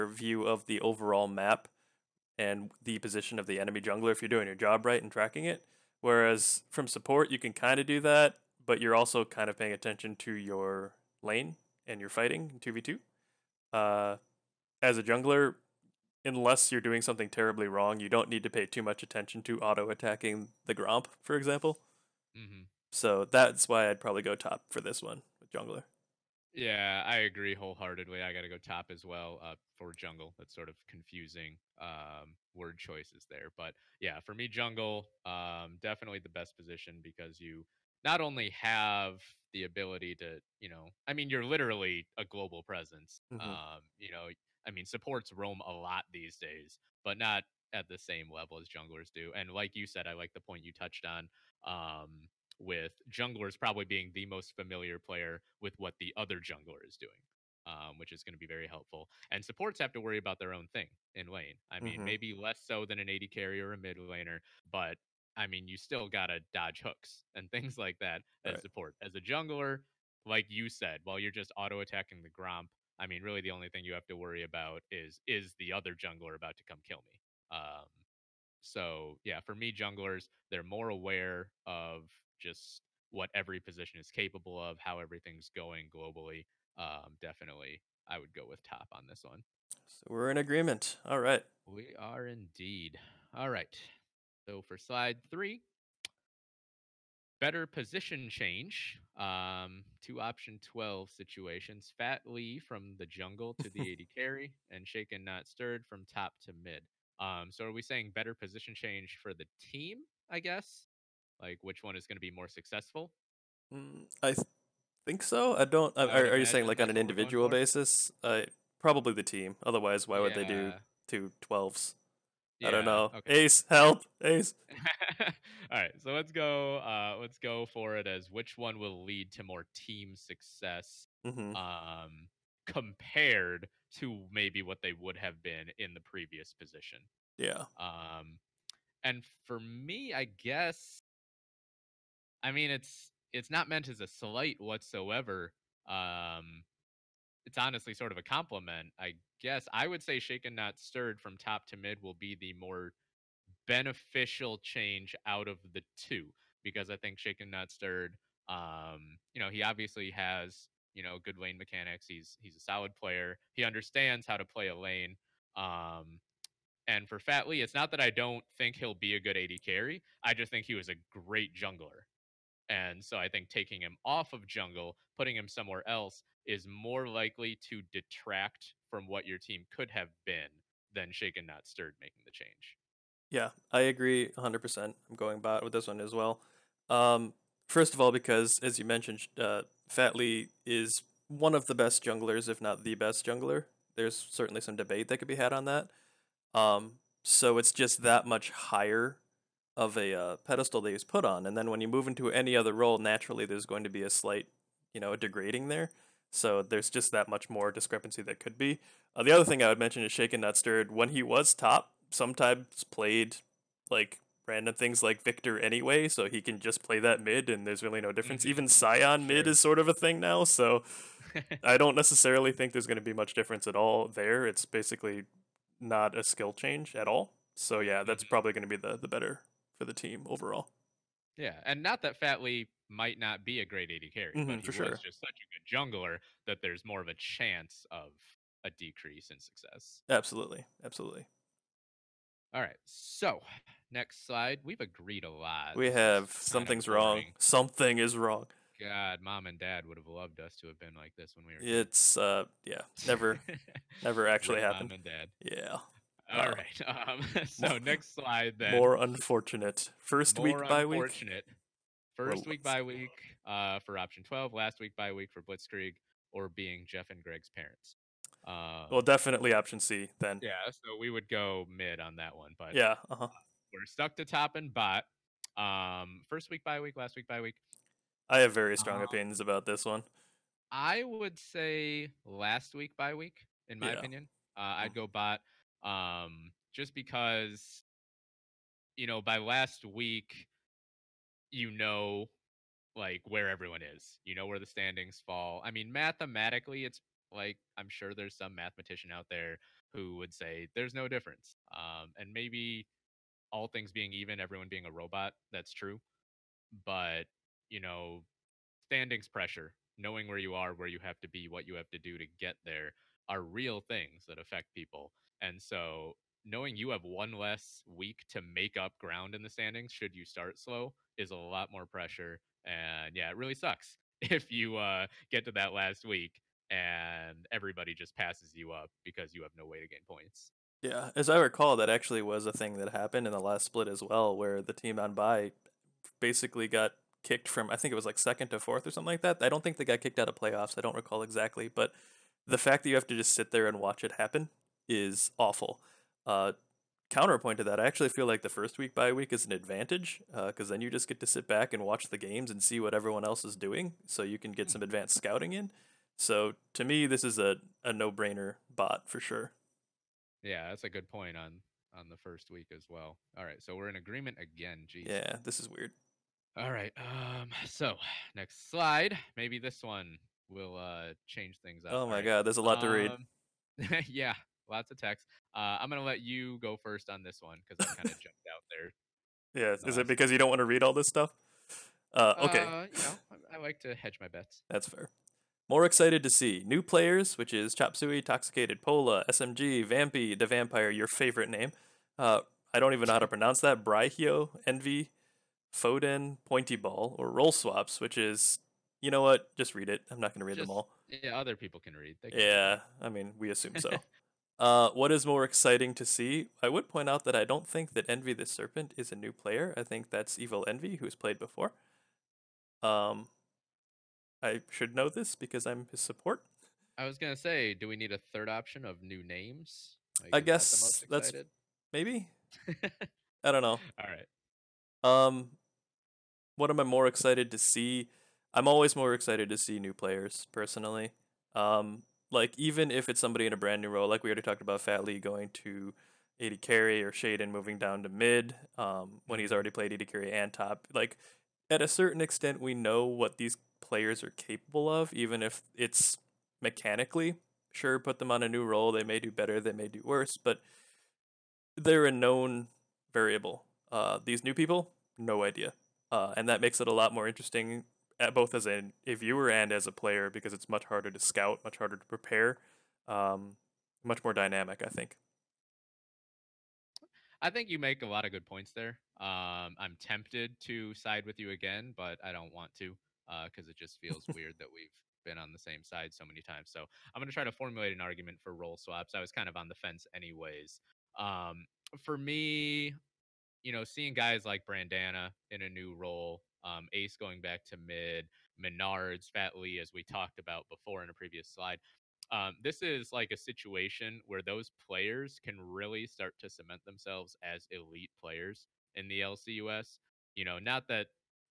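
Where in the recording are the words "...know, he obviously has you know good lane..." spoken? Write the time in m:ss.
2:39.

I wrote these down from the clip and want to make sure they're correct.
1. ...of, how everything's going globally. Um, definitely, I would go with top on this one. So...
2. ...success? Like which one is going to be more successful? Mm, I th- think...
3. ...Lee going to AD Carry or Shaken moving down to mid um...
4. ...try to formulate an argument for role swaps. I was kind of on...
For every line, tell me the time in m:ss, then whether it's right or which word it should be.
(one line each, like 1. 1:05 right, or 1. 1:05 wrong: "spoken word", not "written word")
1. 1:24 right
2. 1:50 wrong: "guess", not "success"
3. 7:15 right
4. 7:57 right.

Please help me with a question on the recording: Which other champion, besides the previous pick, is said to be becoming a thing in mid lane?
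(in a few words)
Sion.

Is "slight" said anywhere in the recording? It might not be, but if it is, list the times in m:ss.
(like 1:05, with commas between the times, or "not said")
2:24, 3:24.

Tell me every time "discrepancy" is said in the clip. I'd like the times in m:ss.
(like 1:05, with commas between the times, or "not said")
3:27.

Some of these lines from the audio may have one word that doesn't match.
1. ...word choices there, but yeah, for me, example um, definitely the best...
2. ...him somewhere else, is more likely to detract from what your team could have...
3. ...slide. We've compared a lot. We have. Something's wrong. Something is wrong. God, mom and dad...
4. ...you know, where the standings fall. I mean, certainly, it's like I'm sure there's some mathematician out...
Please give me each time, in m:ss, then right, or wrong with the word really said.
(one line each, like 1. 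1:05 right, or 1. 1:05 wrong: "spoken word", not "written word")
1. 0:32 wrong: "jungle", not "example"
2. 2:55 right
3. 4:04 wrong: "agreed", not "compared"
4. 4:54 wrong: "mathematically", not "certainly".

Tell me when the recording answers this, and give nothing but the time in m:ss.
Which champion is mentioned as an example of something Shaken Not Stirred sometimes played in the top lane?
3:35.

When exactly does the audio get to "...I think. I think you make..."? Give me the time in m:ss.
7:44.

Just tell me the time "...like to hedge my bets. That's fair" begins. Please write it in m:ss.
6:23.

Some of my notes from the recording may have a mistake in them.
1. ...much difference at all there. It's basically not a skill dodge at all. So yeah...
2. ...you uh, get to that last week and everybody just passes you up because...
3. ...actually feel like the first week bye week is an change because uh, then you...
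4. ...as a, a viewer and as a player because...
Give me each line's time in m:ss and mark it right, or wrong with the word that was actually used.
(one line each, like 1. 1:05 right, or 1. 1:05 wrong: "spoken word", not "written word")
1. 3:43 wrong: "change", not "dodge"
2. 5:24 right
3. 5:47 wrong: "advantage", not "change"
4. 7:38 right.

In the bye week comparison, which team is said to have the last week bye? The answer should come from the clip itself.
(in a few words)
Blitzkrieg.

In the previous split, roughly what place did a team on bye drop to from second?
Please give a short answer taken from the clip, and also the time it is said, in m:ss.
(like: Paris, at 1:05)
fourth, at 5:38.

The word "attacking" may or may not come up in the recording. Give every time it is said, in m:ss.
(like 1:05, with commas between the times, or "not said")
0:19, 1:11.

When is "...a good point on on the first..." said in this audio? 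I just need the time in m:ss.
6:00.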